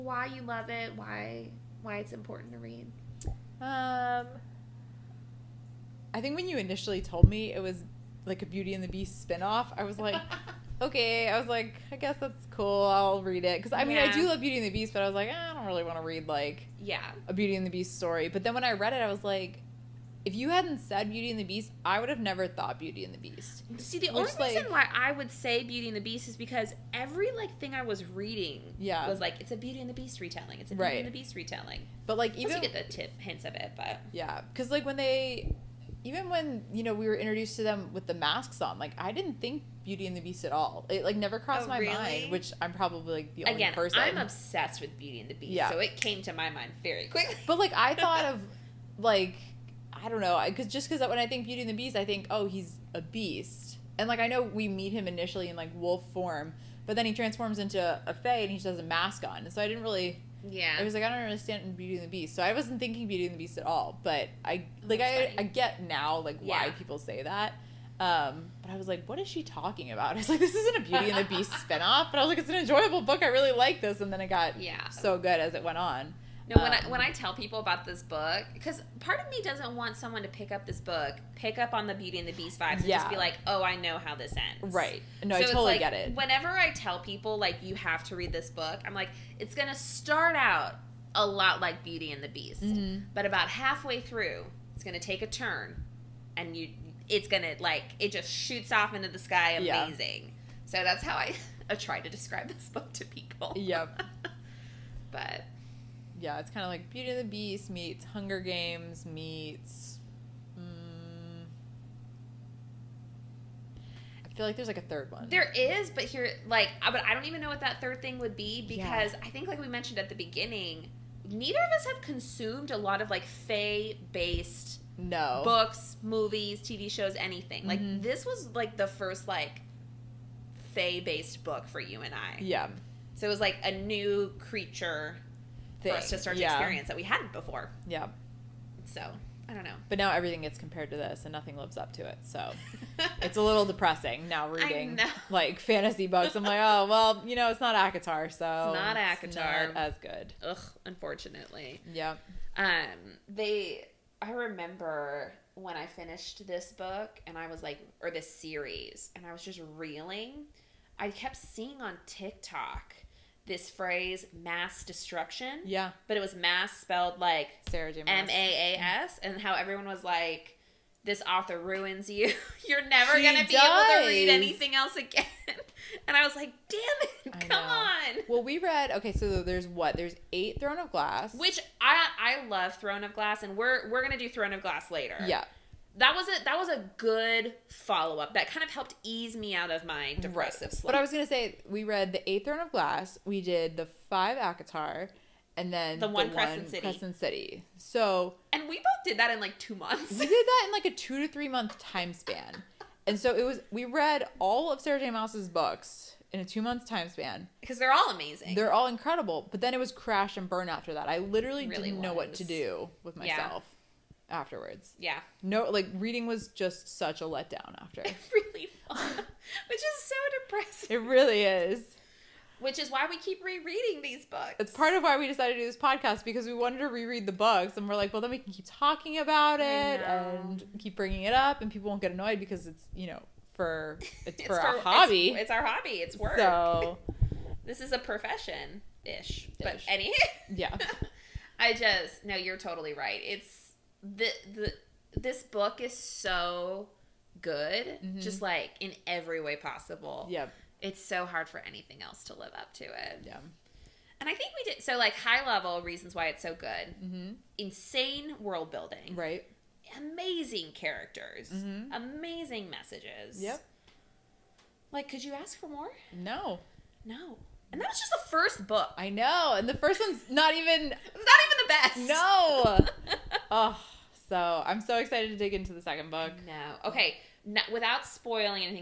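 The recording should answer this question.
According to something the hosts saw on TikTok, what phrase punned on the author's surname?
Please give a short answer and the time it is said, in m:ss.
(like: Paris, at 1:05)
mass destruction, at 2:44.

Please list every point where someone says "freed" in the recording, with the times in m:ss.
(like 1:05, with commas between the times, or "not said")
not said.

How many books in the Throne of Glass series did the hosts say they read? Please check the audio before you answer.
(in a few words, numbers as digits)
8.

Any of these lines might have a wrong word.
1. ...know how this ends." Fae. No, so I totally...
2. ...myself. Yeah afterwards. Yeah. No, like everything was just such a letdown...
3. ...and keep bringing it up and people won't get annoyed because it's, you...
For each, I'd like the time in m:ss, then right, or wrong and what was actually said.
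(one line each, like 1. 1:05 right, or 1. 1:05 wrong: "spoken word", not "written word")
1. 1:23 wrong: "Right", not "Fae"
2. 3:33 wrong: "reading", not "everything"
3. 3:50 right.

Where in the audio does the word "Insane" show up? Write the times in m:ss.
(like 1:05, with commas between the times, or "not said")
4:17.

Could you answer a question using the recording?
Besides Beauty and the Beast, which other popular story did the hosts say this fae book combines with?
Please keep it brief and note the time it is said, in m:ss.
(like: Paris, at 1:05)
Hunger Games, at 1:48.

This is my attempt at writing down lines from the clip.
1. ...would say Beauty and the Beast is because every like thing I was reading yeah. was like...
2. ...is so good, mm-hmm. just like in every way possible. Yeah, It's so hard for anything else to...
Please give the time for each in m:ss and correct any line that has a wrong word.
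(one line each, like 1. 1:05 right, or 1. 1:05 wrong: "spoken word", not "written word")
1. 0:25 right
2. 4:05 right.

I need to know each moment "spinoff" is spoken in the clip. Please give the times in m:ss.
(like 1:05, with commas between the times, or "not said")
0:09, 1:11.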